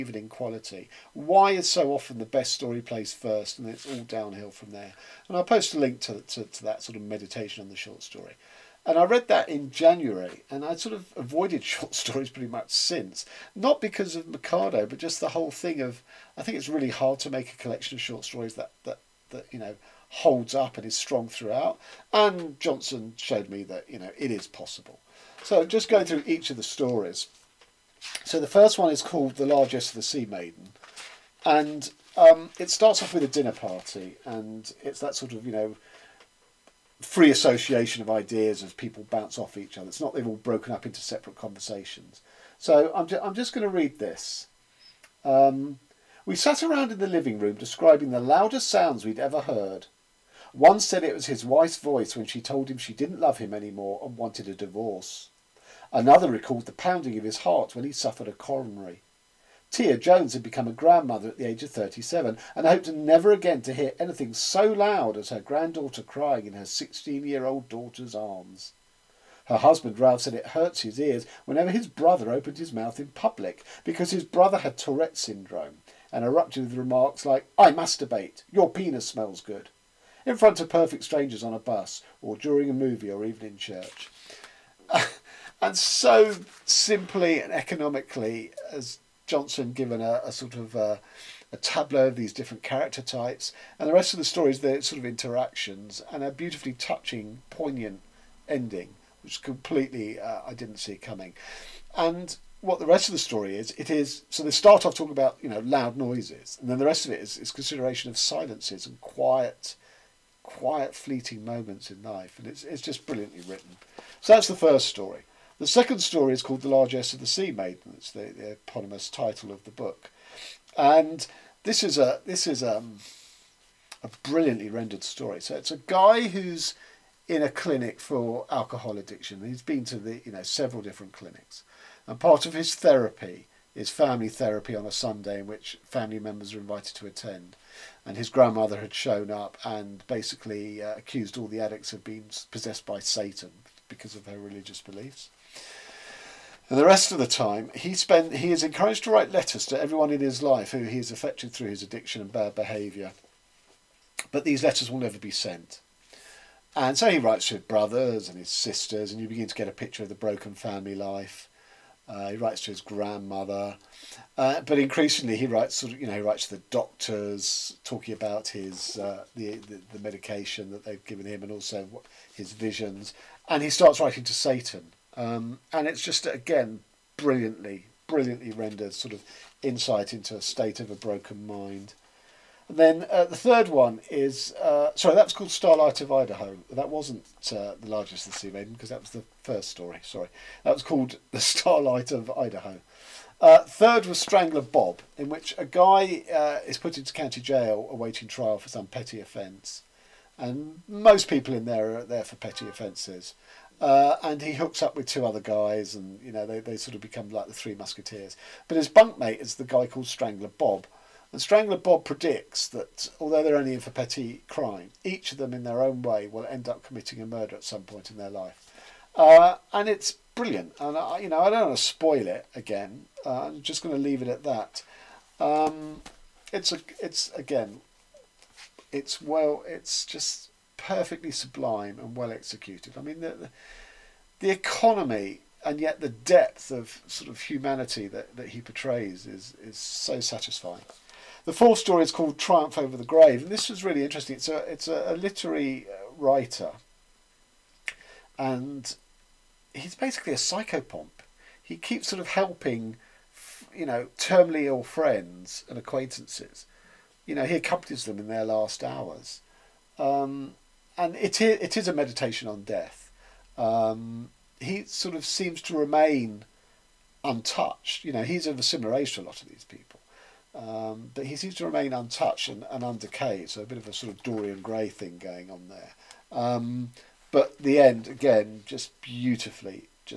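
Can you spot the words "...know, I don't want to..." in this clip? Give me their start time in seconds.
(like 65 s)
221 s.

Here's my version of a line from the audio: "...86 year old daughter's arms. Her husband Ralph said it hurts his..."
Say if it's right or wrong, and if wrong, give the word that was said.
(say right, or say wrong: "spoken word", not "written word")
wrong: "16", not "86".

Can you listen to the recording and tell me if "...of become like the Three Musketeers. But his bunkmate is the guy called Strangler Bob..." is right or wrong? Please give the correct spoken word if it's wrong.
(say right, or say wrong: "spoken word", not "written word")
right.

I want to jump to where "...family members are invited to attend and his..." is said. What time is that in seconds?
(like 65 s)
135 s.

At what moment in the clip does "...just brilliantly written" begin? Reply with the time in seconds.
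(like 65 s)
112 s.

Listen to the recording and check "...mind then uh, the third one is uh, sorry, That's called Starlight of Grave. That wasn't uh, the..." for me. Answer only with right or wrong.
wrong.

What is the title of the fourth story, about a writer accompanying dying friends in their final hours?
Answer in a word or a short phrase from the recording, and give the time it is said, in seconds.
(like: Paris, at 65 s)
Triumph Over the Grave, at 242 s.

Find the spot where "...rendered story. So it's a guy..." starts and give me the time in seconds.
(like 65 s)
124 s.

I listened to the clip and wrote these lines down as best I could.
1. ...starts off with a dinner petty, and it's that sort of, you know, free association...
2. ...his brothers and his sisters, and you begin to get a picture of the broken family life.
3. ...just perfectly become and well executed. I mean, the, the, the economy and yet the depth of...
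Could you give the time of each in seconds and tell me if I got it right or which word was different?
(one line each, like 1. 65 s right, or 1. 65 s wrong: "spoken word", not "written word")
1. 32 s wrong: "party", not "petty"
2. 157 s right
3. 230 s wrong: "sublime", not "become".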